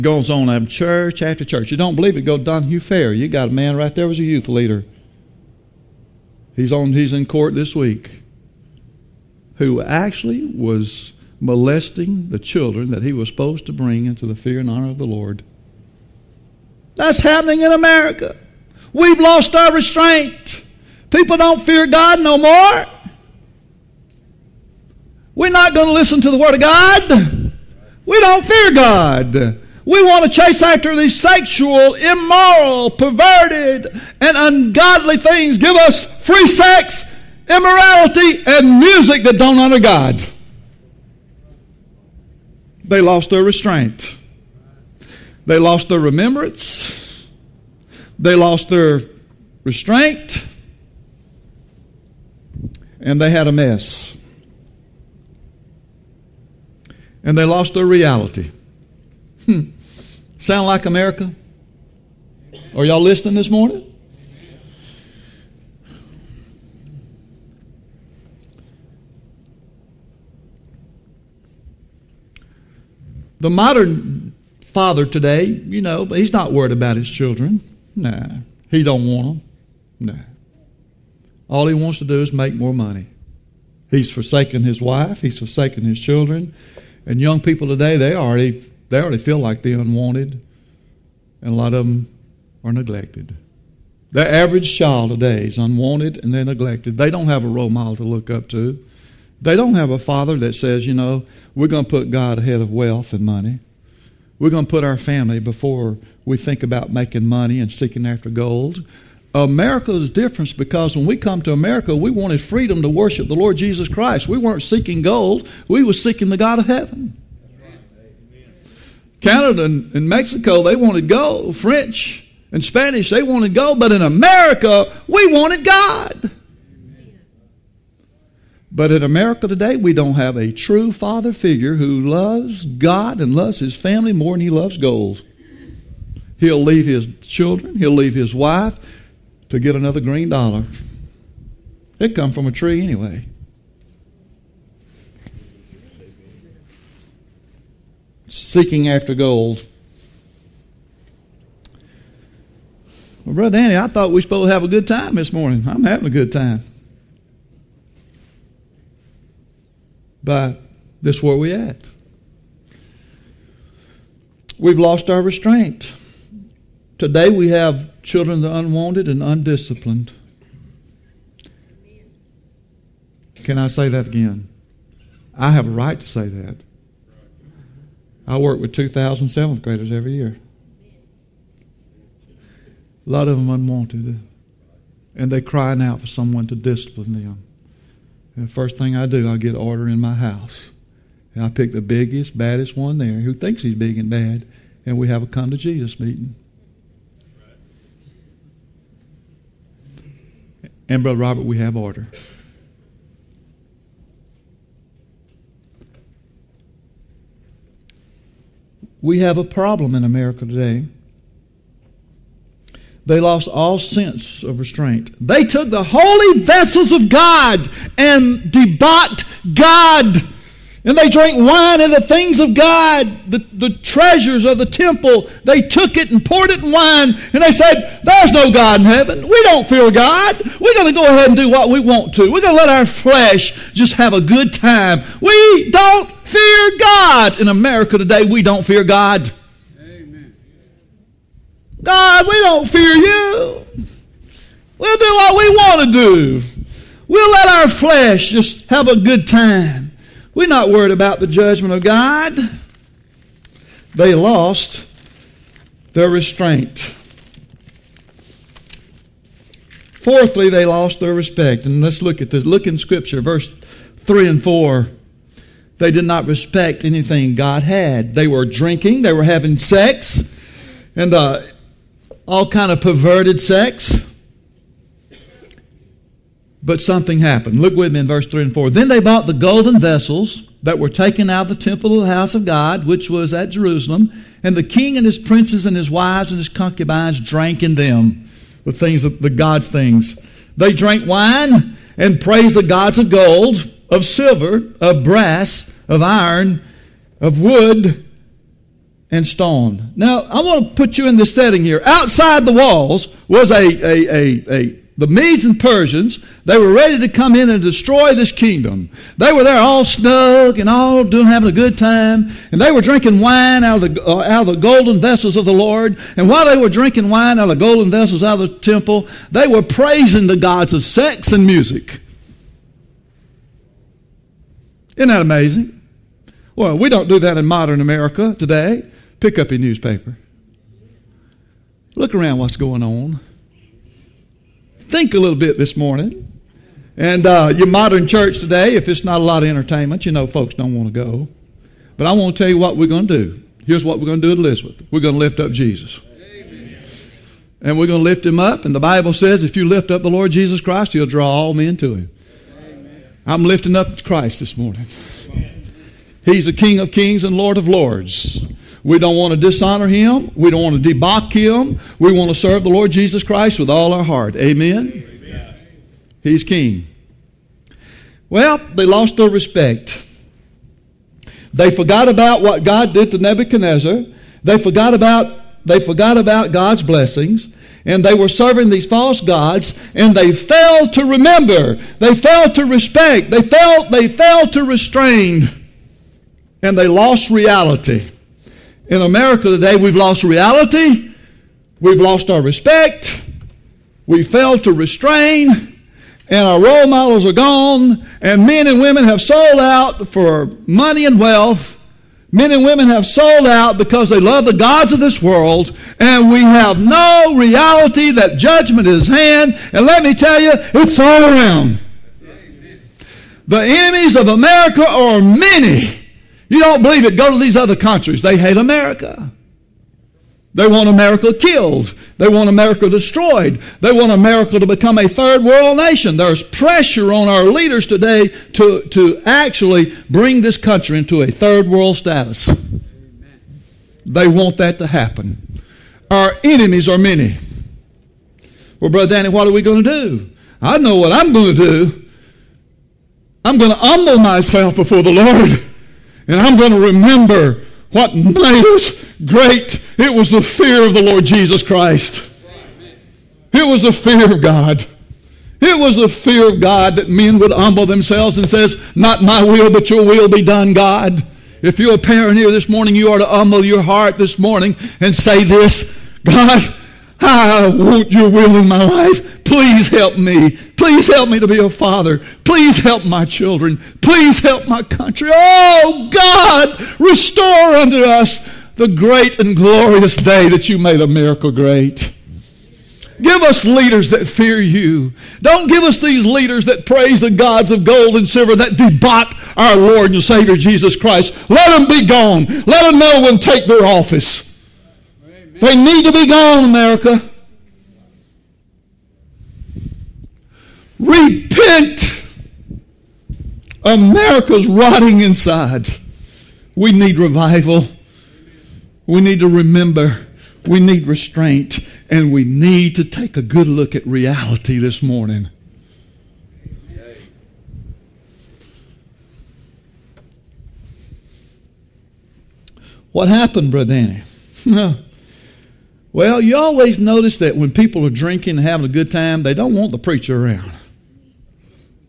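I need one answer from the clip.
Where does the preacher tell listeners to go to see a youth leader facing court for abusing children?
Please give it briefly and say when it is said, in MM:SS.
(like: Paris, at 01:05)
Donahue Fair, at 00:02.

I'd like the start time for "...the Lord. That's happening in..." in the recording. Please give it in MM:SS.
00:14.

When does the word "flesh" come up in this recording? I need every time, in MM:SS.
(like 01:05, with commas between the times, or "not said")
03:52, 04:07.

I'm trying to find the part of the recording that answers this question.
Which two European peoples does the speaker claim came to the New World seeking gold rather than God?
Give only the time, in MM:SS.
02:01.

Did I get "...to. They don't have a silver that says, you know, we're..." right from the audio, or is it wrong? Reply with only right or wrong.
wrong.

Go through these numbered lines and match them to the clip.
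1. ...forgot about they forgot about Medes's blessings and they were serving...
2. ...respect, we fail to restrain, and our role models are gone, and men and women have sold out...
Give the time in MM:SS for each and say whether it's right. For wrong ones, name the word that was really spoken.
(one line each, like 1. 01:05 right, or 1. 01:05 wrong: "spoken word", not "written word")
1. 06:14 wrong: "God", not "Medes"
2. 06:32 right.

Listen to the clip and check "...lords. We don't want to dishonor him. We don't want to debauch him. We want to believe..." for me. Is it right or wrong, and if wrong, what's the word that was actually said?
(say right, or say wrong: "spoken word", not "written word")
wrong: "serve", not "believe".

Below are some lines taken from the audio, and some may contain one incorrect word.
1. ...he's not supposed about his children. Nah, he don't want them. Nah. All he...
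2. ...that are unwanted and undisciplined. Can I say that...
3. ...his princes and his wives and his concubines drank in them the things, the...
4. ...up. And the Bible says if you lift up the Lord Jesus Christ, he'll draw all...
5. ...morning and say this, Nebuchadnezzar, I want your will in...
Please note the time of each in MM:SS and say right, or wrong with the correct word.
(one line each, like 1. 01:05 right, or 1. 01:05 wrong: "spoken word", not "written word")
1. 01:16 wrong: "worried", not "supposed"
2. 02:48 right
3. 04:45 right
4. 05:48 right
5. 07:44 wrong: "God", not "Nebuchadnezzar".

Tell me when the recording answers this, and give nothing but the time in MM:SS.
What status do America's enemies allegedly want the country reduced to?
07:05.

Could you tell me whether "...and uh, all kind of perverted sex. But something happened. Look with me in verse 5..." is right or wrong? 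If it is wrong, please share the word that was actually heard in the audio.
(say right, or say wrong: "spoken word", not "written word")
wrong: "3", not "5".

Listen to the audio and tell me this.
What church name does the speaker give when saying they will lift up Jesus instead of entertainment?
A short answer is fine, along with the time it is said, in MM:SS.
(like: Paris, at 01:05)
Elizabeth, at 05:44.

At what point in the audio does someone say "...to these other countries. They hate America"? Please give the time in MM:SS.
06:57.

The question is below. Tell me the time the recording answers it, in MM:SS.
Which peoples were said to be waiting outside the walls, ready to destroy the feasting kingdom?
05:04.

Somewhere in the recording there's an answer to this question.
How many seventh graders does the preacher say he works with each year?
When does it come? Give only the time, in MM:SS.
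02:58.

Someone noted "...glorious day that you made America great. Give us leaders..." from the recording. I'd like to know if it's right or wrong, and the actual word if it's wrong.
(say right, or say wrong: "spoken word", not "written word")
right.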